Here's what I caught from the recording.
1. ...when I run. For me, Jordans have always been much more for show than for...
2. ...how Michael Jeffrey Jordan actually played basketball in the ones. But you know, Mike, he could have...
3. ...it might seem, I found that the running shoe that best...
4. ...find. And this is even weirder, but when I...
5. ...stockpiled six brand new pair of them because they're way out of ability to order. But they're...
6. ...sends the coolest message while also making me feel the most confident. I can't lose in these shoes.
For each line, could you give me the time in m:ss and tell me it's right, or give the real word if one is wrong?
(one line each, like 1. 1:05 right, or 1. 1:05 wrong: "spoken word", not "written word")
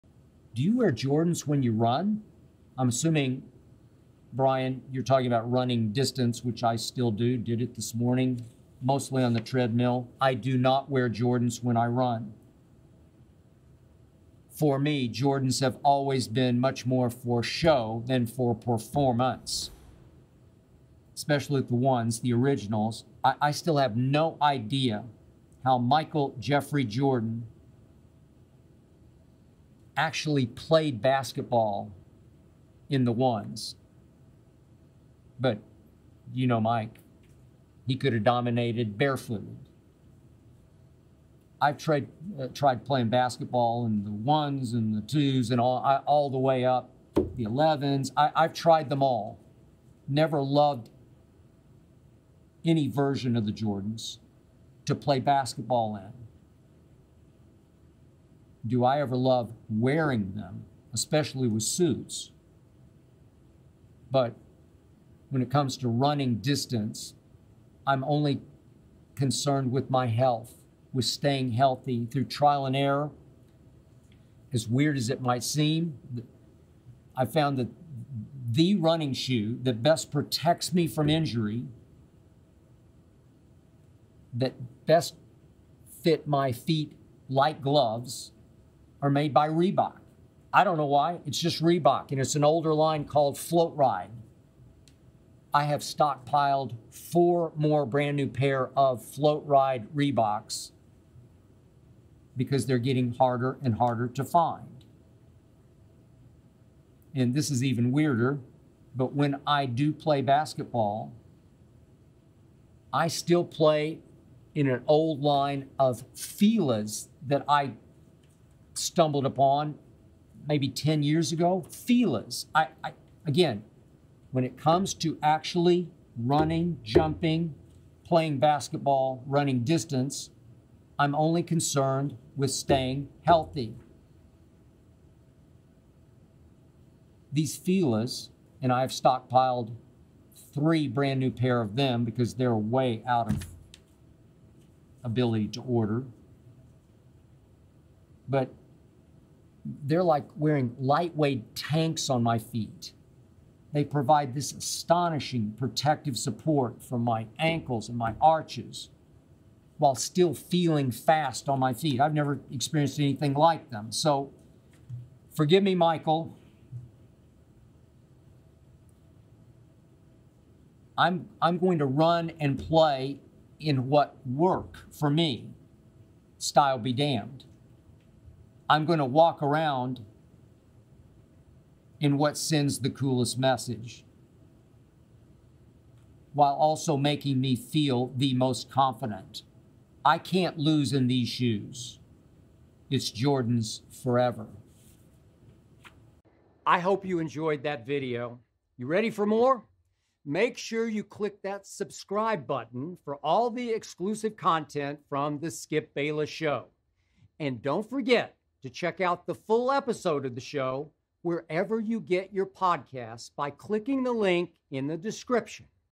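1. 0:11 right
2. 0:25 right
3. 1:15 right
4. 1:44 right
5. 2:18 wrong: "three", not "six"
6. 3:02 right.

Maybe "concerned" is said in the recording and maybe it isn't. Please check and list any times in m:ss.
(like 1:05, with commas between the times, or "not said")
1:09, 2:11.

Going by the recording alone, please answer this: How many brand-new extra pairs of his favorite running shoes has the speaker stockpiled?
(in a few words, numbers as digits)
4.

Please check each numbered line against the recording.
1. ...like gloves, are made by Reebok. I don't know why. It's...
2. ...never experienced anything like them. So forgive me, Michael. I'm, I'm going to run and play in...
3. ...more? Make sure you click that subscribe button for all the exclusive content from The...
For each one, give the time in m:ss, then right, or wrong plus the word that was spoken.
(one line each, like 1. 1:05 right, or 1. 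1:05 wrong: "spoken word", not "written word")
1. 1:27 right
2. 2:42 right
3. 3:19 right.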